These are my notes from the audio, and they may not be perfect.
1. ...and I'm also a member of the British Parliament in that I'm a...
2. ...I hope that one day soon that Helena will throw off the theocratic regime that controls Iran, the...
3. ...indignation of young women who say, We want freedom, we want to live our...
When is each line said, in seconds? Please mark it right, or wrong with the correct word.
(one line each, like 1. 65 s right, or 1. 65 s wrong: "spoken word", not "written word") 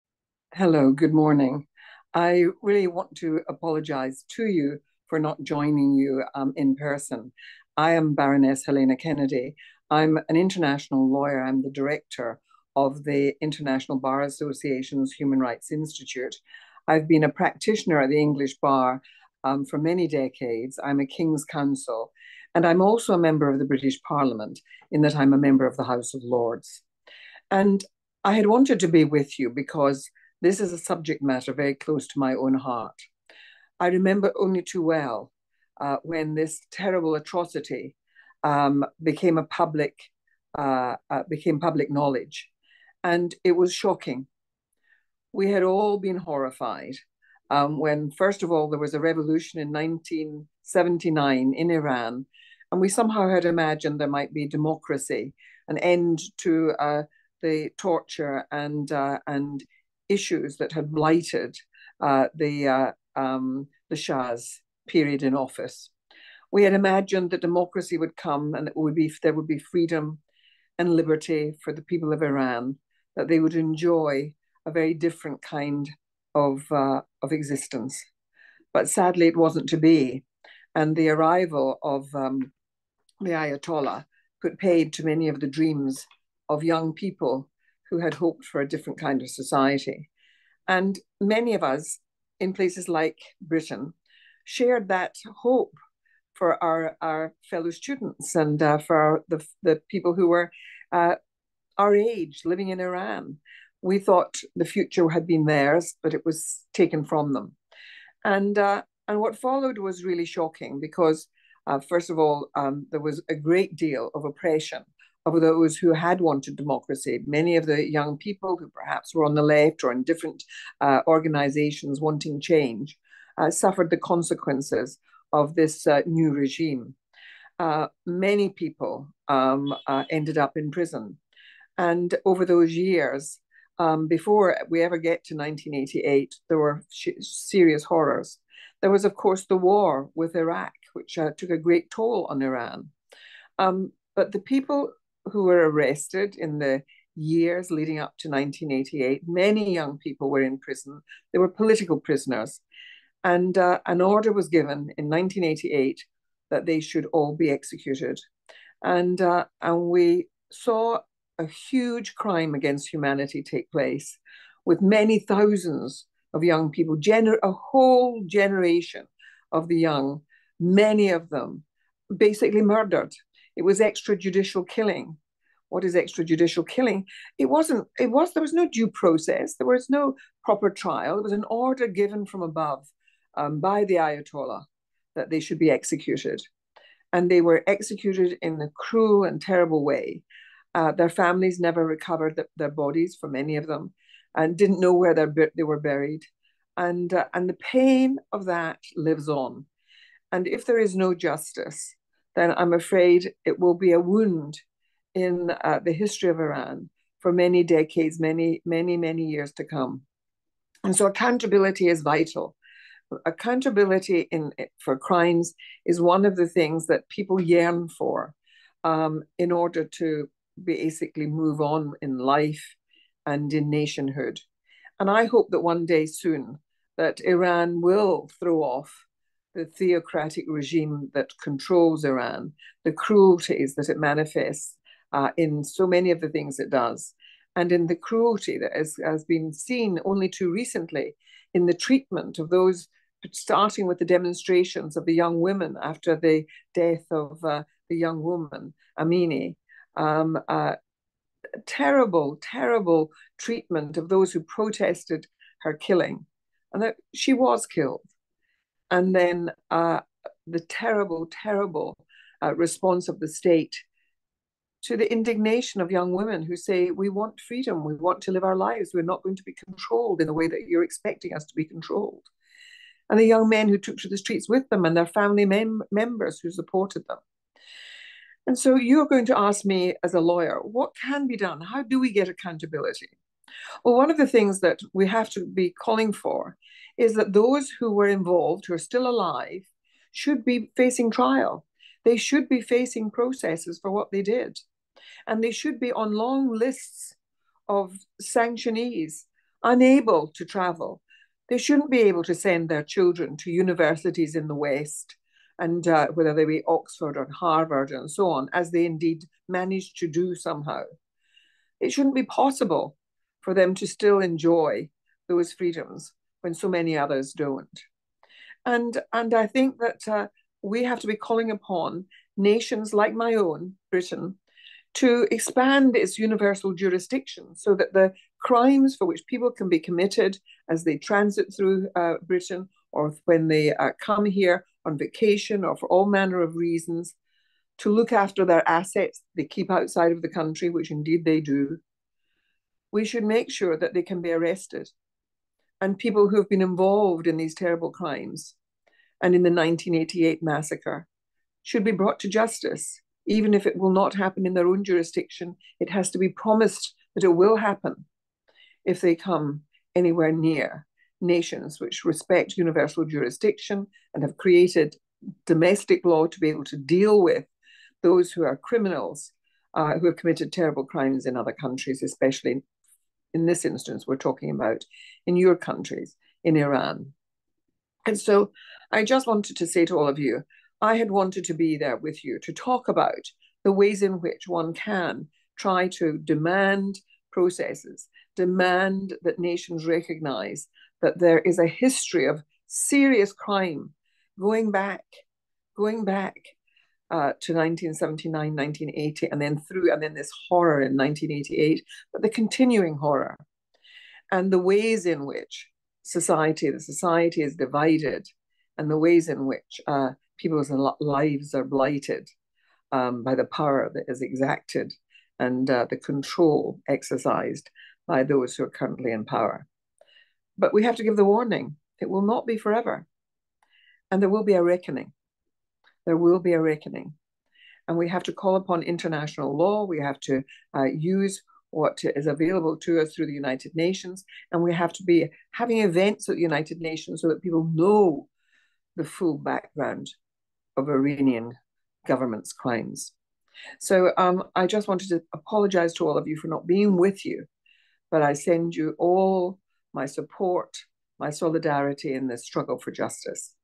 1. 22 s right
2. 225 s wrong: "Iran", not "Helena"
3. 265 s right.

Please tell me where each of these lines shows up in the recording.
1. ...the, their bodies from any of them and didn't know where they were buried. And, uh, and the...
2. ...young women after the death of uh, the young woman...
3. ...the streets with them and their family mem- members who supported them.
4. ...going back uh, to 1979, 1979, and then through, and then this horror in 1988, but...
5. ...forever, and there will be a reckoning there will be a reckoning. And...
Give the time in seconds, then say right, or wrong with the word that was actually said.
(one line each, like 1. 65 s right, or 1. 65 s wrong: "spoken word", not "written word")
1. 192 s right
2. 245 s right
3. 274 s right
4. 395 s wrong: "1980", not "1979"
5. 422 s right.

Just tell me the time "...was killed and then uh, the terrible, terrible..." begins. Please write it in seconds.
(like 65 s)
257 s.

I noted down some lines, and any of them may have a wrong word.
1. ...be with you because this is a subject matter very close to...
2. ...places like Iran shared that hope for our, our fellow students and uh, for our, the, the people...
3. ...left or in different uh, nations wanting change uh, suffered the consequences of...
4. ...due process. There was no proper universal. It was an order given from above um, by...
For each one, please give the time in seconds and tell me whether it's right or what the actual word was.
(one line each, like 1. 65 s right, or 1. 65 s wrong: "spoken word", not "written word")
1. 28 s right
2. 92 s wrong: "Britain", not "Iran"
3. 119 s wrong: "organizations", not "nations"
4. 178 s wrong: "trial", not "universal".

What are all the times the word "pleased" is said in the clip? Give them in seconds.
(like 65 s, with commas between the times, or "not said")
not said.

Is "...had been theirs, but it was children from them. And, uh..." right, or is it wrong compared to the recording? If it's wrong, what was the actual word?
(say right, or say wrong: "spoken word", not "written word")
wrong: "taken", not "children".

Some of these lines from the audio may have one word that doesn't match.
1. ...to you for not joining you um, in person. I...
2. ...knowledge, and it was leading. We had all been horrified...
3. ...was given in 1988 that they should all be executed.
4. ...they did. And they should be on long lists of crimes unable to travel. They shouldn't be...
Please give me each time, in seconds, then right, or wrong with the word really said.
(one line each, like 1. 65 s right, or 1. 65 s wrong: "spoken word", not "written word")
1. 4 s right
2. 41 s wrong: "shocking", not "leading"
3. 154 s right
4. 294 s wrong: "sanctionees", not "crimes".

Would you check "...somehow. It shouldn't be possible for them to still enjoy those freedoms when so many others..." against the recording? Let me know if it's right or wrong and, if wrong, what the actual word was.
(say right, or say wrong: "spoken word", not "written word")
right.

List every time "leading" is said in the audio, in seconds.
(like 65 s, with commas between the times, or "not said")
147 s.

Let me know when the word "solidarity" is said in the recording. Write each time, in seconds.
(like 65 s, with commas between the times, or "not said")
451 s.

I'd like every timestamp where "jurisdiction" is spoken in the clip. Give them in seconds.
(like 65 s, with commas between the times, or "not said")
326 s, 354 s, 363 s.